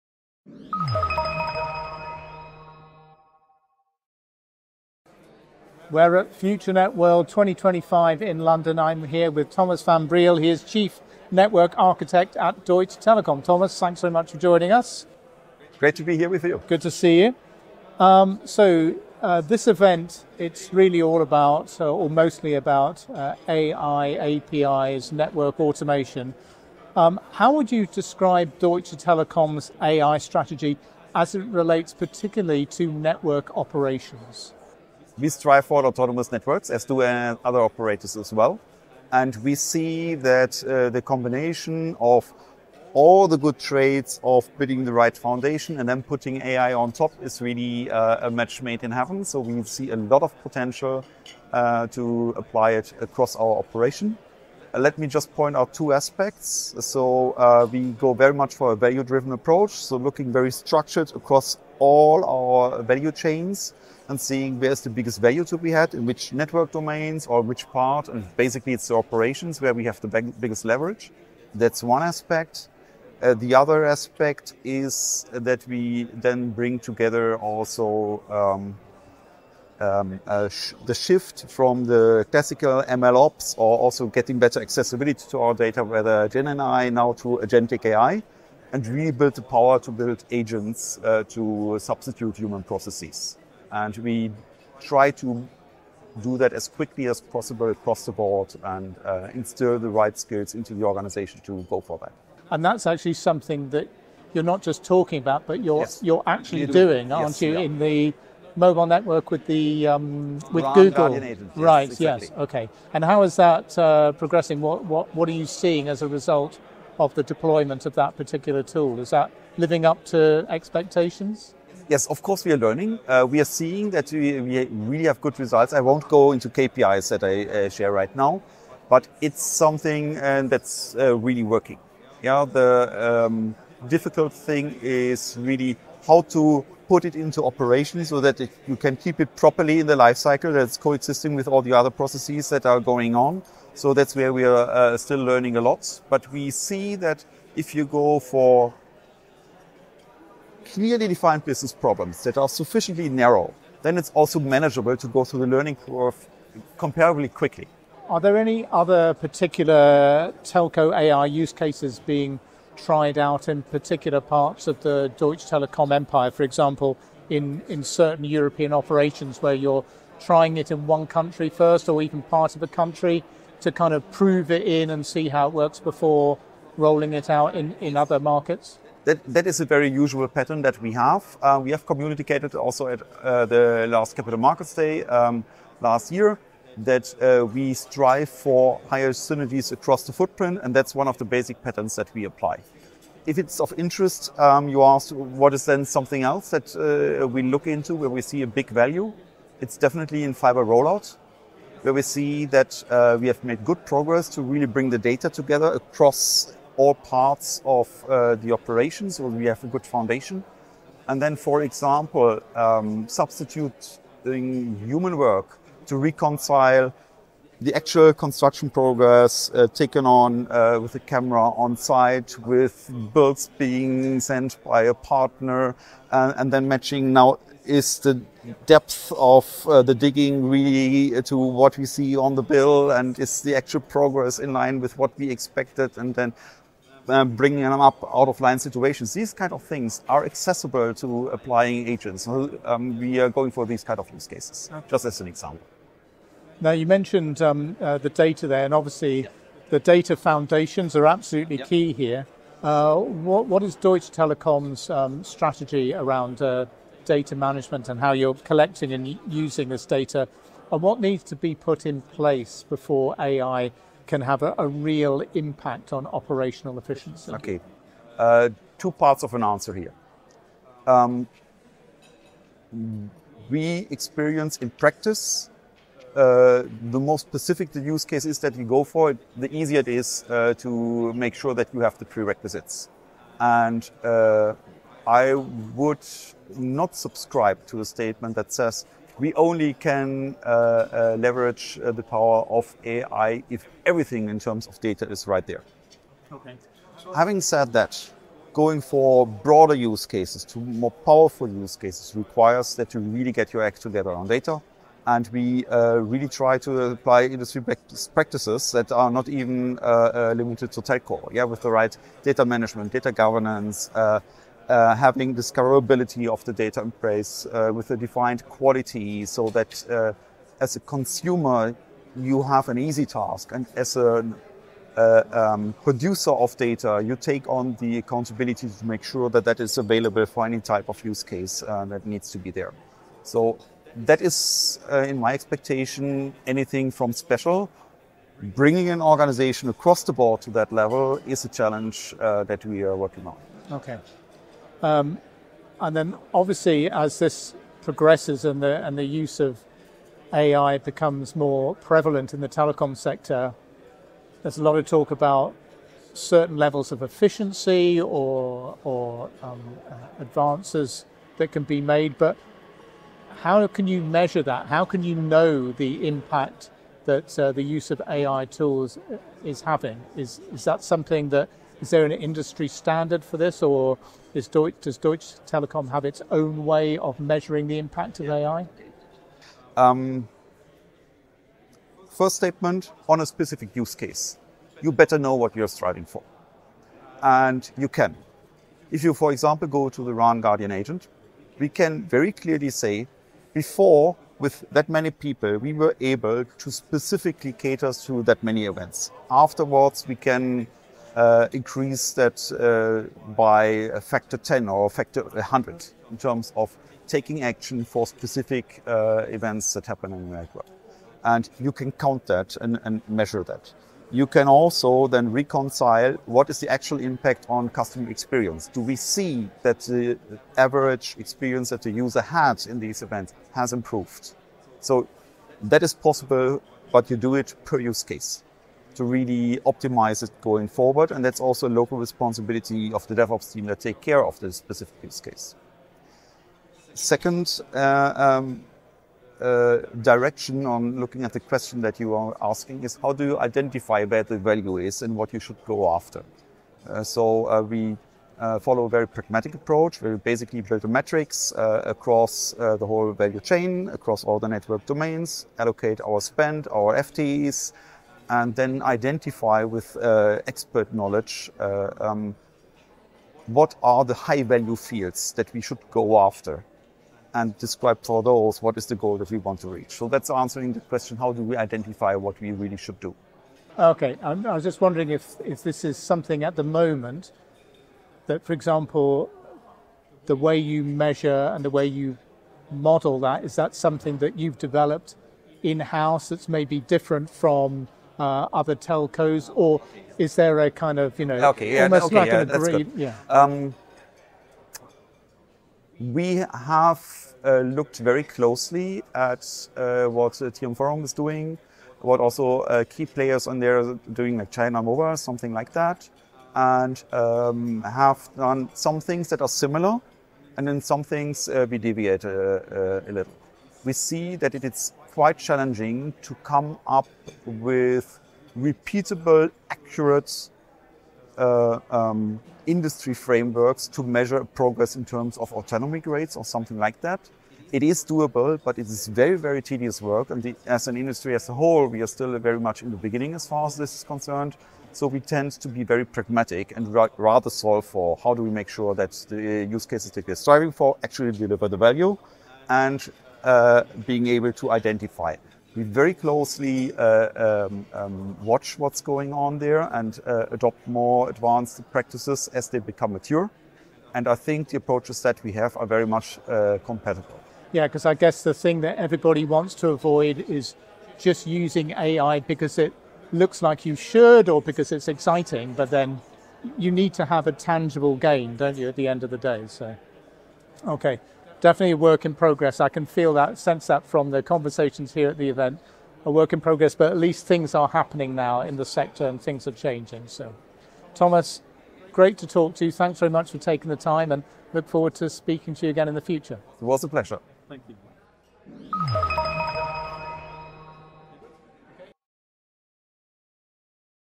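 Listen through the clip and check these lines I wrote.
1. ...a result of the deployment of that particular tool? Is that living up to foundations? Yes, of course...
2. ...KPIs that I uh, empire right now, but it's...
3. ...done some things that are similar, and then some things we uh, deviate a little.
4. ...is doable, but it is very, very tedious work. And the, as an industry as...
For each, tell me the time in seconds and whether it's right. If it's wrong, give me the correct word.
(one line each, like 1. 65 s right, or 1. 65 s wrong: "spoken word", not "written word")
1. 116 s wrong: "expectations", not "foundations"
2. 126 s wrong: "share", not "empire"
3. 508 s right
4. 527 s right.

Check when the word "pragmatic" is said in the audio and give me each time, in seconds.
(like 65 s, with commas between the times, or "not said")
449 s, 536 s.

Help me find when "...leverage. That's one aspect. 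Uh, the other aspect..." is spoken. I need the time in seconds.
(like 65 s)
70 s.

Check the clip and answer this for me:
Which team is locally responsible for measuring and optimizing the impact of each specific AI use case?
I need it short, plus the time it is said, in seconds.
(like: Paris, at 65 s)
DevOps team, at 433 s.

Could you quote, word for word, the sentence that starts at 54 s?
Uh, let me just point out two aspects.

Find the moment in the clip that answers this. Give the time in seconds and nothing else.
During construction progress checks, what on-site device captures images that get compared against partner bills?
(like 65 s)
221 s.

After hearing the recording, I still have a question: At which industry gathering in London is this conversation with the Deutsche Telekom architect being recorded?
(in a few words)
FutureNet World 2025.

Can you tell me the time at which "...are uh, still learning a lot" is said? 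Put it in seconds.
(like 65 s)
144 s.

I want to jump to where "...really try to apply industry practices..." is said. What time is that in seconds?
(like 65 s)
305 s.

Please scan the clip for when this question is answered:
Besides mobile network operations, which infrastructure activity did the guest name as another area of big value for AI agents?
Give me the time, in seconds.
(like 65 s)
200 s.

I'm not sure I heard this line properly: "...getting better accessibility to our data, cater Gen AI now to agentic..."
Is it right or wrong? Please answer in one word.
wrong.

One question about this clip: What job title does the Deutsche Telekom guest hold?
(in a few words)
Chief Network Architect.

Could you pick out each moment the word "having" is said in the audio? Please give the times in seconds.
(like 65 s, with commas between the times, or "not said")
297 s, 314 s, 369 s.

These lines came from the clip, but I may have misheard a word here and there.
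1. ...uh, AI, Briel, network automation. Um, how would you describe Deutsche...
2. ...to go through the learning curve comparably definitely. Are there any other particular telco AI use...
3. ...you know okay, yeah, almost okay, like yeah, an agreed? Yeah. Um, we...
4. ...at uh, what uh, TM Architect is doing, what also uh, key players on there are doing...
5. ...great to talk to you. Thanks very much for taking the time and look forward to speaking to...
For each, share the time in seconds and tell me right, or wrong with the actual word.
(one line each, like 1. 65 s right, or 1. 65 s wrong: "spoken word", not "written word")
1. 23 s wrong: "APIs", not "Briel"
2. 154 s wrong: "quickly", not "definitely"
3. 491 s right
4. 499 s wrong: "Forum", not "Architect"
5. 582 s right.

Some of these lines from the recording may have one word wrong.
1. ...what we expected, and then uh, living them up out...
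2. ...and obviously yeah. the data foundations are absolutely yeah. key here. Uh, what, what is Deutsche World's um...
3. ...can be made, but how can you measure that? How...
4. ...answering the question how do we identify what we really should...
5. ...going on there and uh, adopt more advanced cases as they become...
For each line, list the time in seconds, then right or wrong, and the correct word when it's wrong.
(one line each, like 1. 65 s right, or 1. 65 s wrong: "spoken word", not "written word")
1. 234 s wrong: "bringing", not "living"
2. 248 s wrong: "Telekom", not "World"
3. 361 s right
4. 470 s right
5. 549 s wrong: "practices", not "cases".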